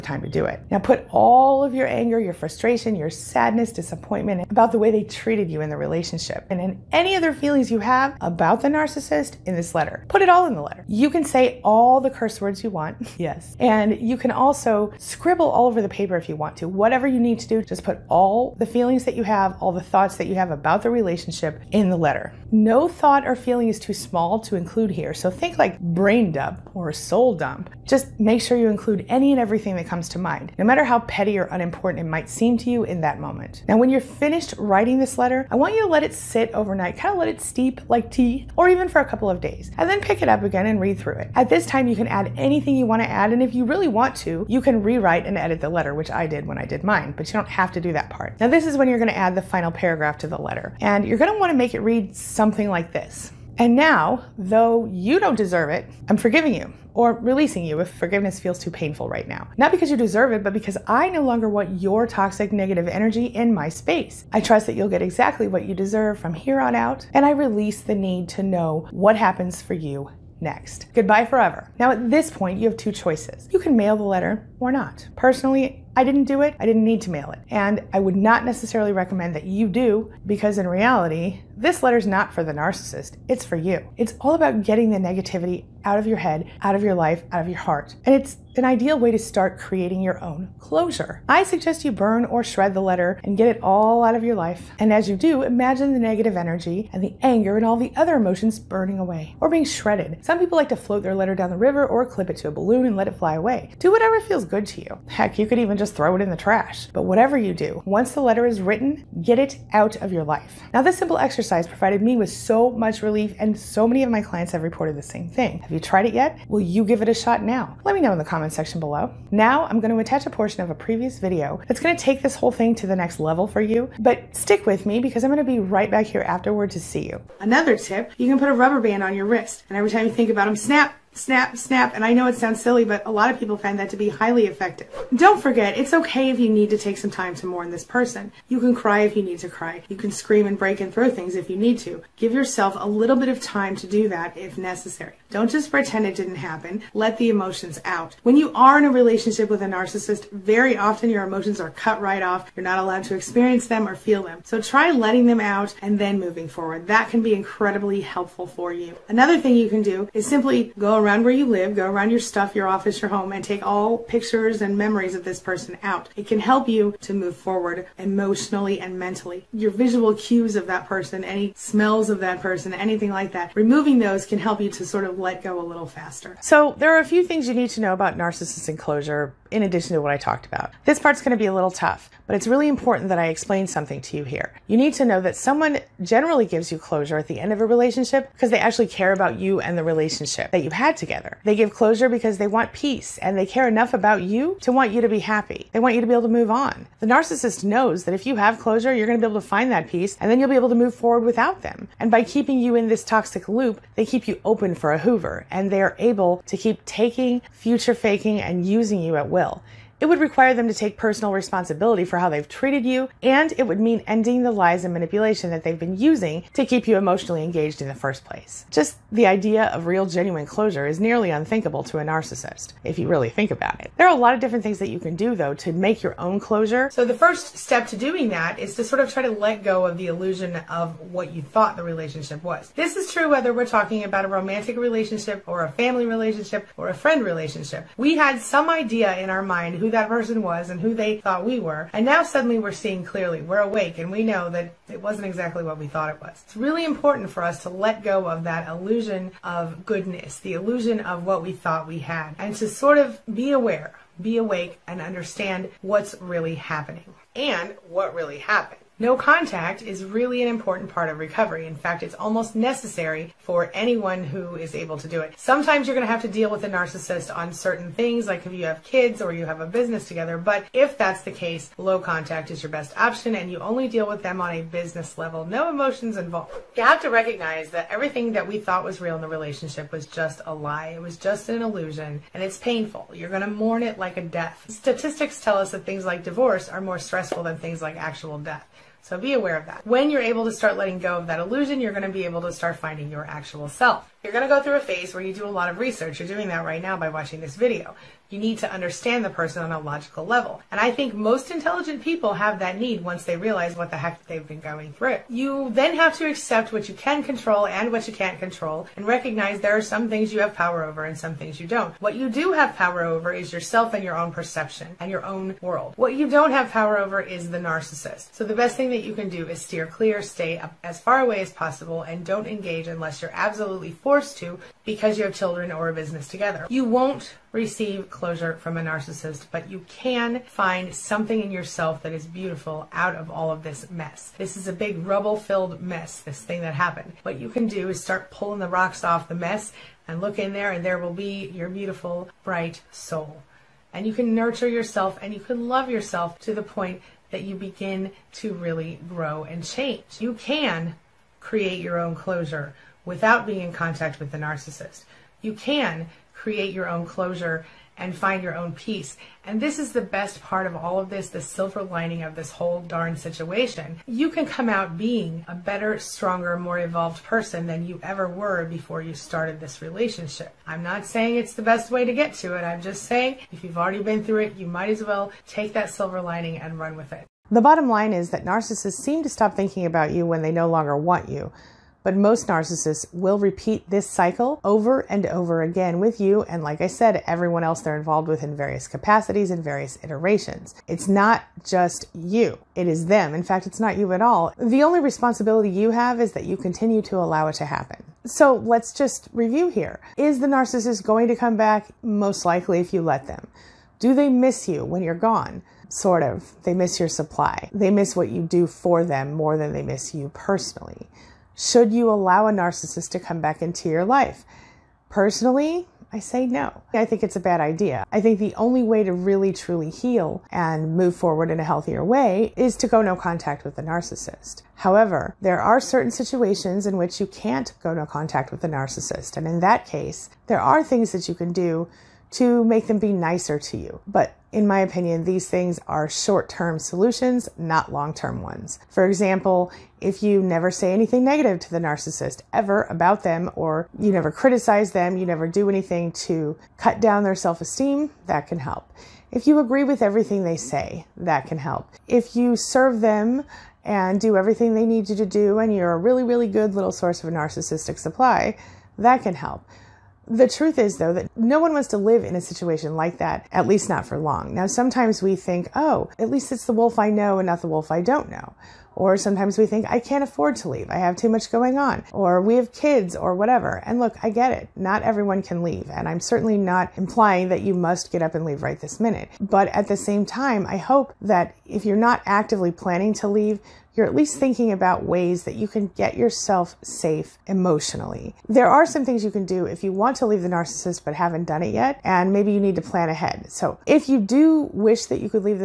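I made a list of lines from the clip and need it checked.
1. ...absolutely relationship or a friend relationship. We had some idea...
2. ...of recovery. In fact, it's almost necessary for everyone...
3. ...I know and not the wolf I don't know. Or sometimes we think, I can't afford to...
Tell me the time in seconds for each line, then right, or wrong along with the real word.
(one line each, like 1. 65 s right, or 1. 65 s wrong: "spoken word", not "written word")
1. 235 s wrong: "family", not "absolutely"
2. 261 s wrong: "anyone", not "everyone"
3. 466 s right.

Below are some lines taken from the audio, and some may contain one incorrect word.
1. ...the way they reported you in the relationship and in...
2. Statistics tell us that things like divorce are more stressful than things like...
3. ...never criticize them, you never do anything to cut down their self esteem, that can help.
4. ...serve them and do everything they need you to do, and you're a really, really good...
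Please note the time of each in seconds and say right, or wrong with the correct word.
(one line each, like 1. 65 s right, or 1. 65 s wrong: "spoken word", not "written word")
1. 4 s wrong: "treated", not "reported"
2. 284 s right
3. 444 s right
4. 452 s right.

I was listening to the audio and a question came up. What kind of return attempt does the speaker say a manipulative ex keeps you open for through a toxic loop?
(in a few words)
a Hoover.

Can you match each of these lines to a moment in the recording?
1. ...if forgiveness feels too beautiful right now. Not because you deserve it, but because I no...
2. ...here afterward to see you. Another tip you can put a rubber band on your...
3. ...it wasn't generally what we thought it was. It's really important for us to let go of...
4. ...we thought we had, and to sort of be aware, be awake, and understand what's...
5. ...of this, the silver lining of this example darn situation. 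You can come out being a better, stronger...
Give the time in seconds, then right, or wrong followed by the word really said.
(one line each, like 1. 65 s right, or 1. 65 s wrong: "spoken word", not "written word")
1. 57 s wrong: "painful", not "beautiful"
2. 126 s right
3. 244 s wrong: "exactly", not "generally"
4. 251 s right
5. 360 s wrong: "whole", not "example".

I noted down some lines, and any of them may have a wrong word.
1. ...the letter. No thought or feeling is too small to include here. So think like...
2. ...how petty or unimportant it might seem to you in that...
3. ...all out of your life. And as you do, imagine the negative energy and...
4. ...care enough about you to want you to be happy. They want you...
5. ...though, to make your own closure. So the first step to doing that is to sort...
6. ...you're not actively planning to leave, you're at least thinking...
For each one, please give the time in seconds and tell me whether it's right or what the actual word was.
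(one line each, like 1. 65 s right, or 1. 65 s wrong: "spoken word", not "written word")
1. 21 s right
2. 30 s right
3. 93 s right
4. 193 s right
5. 225 s right
6. 481 s right.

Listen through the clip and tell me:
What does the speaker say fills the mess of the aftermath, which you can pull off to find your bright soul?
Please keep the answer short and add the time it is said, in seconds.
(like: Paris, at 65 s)
rocks, at 338 s.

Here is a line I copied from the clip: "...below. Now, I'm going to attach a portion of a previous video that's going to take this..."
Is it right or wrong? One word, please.
right.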